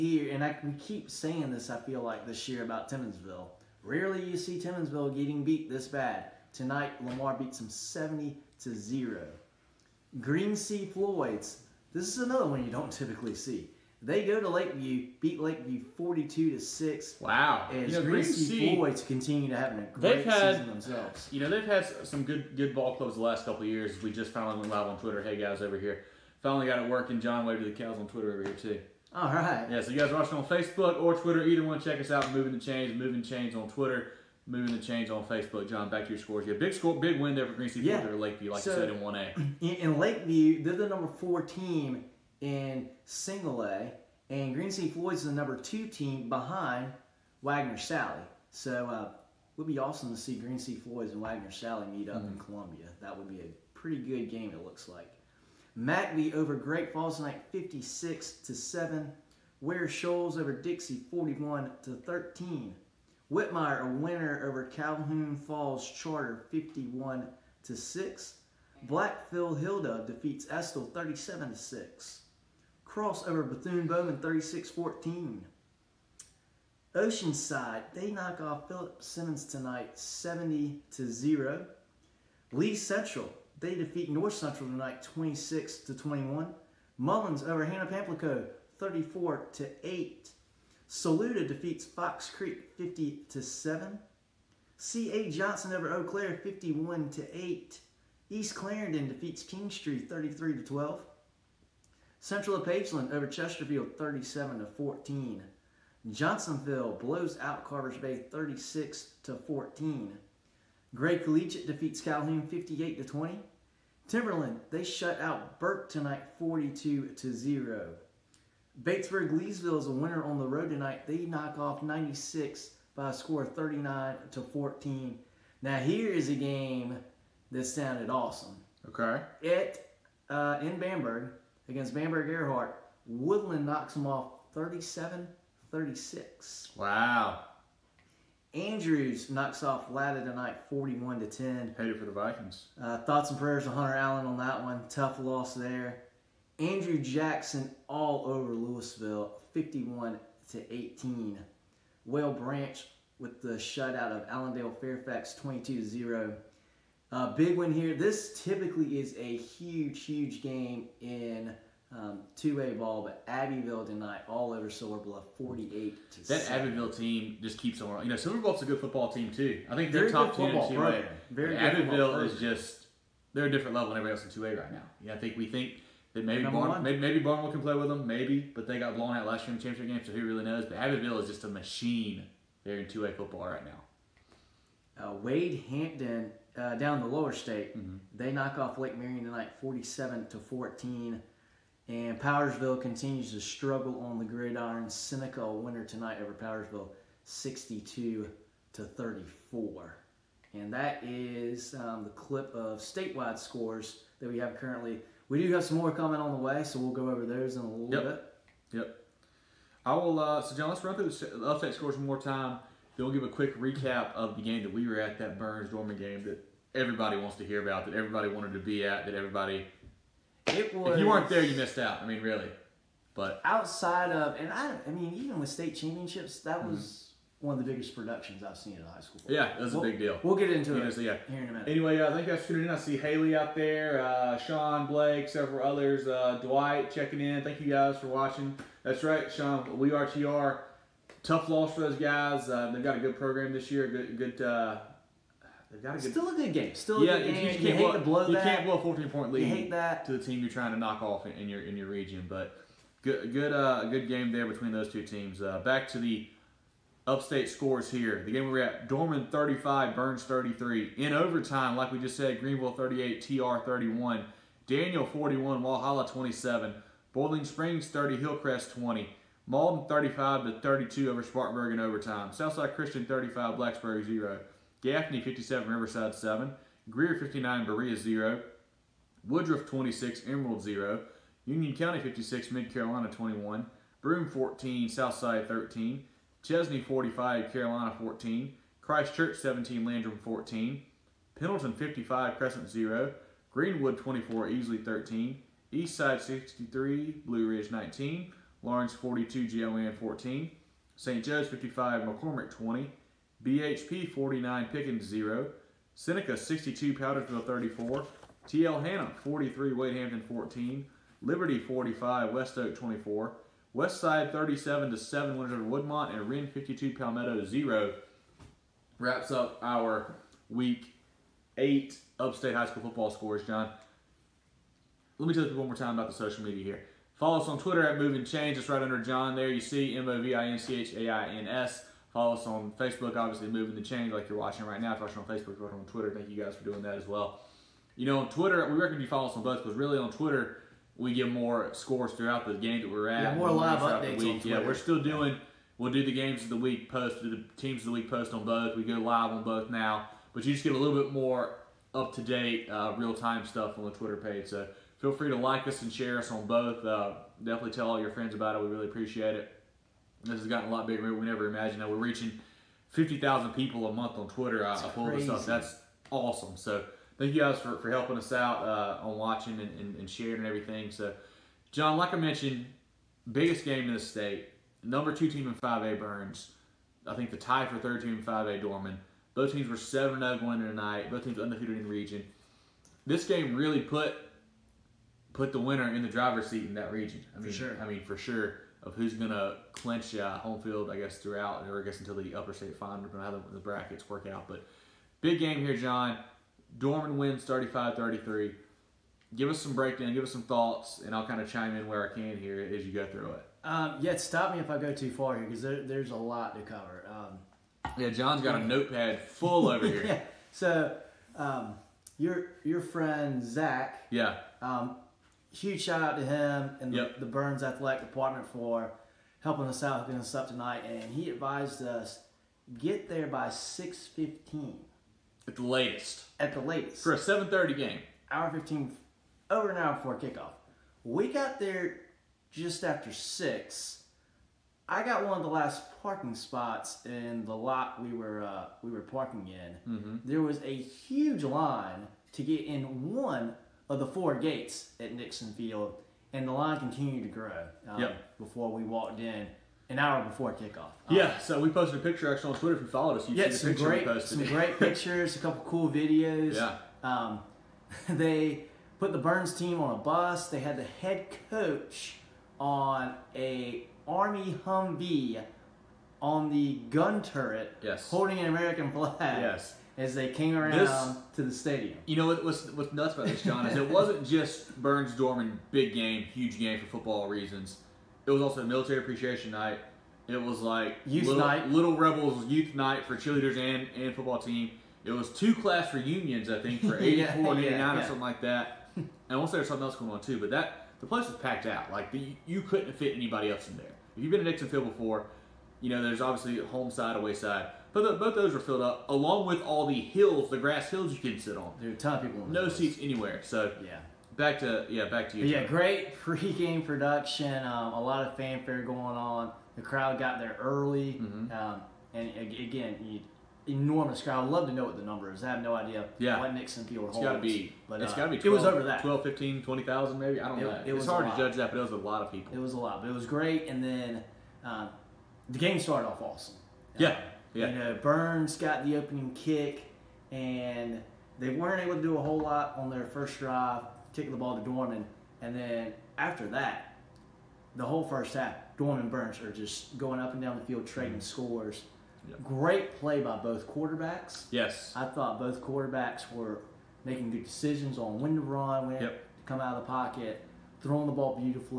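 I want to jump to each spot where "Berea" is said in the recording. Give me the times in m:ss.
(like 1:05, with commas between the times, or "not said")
4:37.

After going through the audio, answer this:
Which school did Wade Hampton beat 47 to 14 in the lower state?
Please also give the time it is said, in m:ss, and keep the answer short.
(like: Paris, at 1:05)
Lake Marion, at 3:08.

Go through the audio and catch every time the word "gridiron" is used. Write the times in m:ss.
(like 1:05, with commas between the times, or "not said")
3:14.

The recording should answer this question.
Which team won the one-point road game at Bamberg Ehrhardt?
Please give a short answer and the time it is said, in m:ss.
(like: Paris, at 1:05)
Woodland, at 2:13.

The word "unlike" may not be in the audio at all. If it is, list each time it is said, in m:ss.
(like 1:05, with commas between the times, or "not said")
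not said.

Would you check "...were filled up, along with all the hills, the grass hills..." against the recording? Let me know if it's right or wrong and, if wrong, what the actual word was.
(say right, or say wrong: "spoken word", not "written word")
right.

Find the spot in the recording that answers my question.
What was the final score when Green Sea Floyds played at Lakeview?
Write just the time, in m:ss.
0:15.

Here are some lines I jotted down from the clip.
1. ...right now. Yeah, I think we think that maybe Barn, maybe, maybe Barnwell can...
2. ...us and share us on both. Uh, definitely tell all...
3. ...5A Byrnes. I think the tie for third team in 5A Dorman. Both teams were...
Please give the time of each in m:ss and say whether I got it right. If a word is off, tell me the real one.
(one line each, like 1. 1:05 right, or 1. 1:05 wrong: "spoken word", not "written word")
1. 2:54 right
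2. 5:55 right
3. 6:15 right.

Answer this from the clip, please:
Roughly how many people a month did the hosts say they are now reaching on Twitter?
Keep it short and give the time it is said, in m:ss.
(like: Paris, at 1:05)
50,000, at 6:02.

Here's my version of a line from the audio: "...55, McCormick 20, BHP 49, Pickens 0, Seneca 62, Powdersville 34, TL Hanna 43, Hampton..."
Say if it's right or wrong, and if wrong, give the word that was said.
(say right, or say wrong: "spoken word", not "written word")
right.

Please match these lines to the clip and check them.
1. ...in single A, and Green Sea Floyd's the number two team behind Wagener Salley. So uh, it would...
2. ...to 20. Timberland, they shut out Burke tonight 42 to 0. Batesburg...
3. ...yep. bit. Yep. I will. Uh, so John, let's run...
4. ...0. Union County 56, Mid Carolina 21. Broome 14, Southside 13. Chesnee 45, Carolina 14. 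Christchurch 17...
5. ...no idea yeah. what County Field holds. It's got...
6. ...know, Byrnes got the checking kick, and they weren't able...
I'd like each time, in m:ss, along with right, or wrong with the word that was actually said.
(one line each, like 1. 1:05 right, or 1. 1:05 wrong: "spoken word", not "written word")
1. 0:42 right
2. 1:52 right
3. 3:27 right
4. 4:40 right
5. 8:35 wrong: "Nixon", not "County"
6. 8:47 wrong: "opening", not "checking".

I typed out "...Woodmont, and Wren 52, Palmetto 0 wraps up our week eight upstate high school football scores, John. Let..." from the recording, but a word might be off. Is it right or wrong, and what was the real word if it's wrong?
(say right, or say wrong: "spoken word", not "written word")
right.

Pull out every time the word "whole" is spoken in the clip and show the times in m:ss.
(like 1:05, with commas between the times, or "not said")
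8:52, 8:57.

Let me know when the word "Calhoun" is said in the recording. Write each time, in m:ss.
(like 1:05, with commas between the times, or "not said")
1:04, 1:51.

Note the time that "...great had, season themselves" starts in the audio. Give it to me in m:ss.
0:19.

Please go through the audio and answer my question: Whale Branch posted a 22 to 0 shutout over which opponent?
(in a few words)
Allendale Fairfax.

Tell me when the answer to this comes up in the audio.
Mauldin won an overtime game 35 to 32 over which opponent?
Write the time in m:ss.
4:31.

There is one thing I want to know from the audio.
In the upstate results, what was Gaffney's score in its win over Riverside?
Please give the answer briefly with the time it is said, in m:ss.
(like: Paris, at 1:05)
57, at 4:35.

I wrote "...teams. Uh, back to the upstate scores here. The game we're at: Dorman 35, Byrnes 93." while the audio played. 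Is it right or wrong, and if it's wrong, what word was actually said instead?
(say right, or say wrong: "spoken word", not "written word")
wrong: "33", not "93".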